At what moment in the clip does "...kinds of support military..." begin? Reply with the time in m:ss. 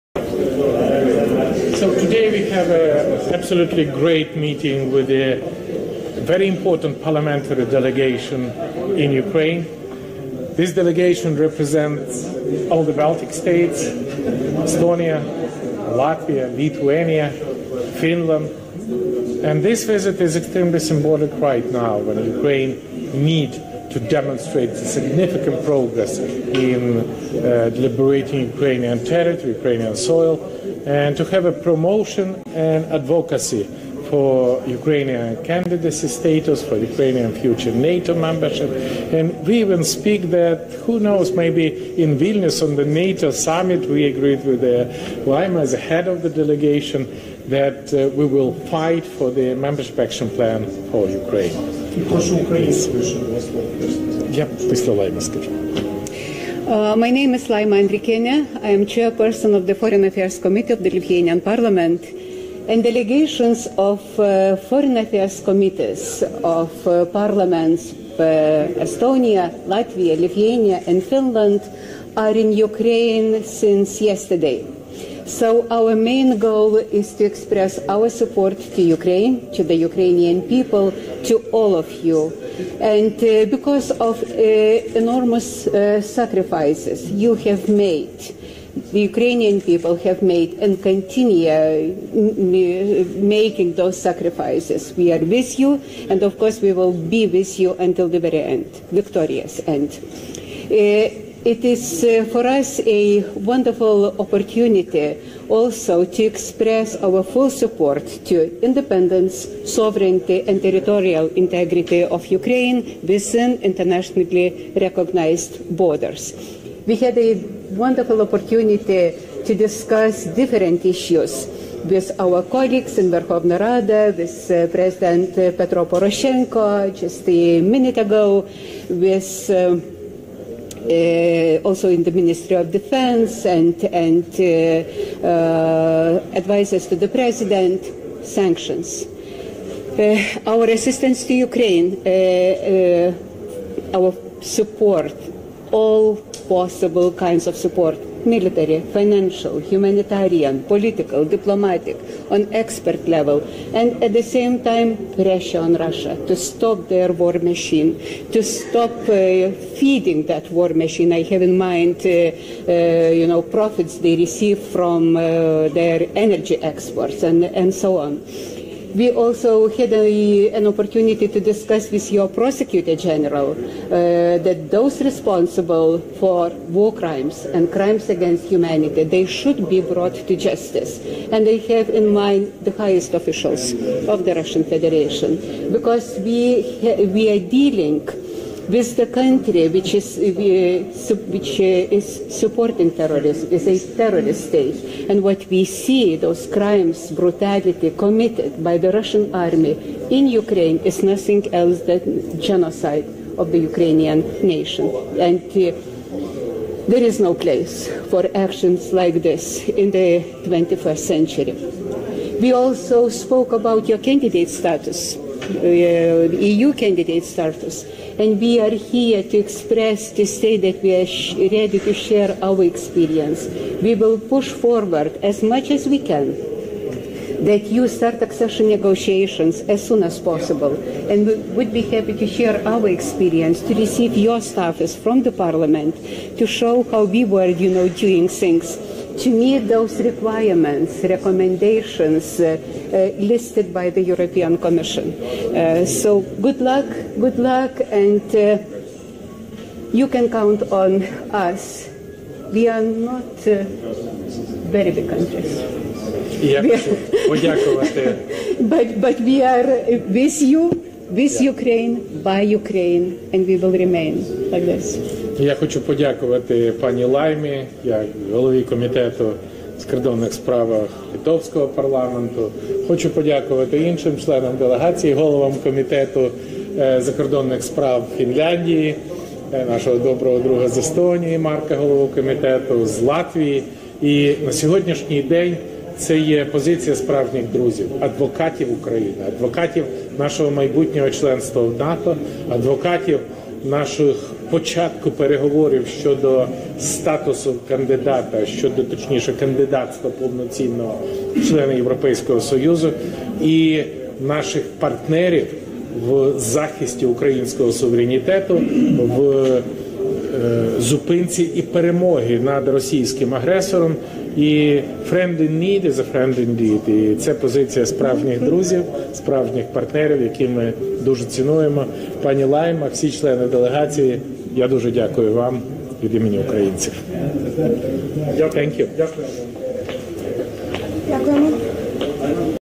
2:27.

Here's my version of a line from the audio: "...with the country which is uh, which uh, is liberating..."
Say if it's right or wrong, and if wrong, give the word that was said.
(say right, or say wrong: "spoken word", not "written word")
wrong: "supporting", not "liberating".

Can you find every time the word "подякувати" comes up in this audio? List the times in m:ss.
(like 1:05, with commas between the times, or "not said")
4:25, 4:33.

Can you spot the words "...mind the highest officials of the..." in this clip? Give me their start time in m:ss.
3:02.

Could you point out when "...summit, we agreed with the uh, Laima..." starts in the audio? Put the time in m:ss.
0:43.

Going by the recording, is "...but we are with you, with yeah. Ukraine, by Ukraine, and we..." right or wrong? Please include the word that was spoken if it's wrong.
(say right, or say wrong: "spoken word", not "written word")
right.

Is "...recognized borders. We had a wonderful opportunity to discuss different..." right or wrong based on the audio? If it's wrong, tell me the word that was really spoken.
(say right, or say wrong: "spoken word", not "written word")
right.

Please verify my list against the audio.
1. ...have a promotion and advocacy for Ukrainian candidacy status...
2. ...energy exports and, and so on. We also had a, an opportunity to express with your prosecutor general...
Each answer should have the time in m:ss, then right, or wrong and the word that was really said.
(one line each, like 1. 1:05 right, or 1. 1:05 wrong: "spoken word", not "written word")
1. 0:31 right
2. 2:46 wrong: "discuss", not "express".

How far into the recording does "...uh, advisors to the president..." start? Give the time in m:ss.
2:15.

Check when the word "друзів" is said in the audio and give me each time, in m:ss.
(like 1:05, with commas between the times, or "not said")
4:47, 5:18.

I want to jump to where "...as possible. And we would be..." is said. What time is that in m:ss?
3:50.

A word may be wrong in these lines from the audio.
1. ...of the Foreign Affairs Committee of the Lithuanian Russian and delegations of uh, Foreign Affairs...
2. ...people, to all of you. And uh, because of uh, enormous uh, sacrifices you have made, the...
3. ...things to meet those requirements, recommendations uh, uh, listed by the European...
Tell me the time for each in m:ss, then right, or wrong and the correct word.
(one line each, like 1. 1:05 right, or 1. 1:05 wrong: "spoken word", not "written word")
1. 0:59 wrong: "Parliament", not "Russian"
2. 1:20 right
3. 3:58 right.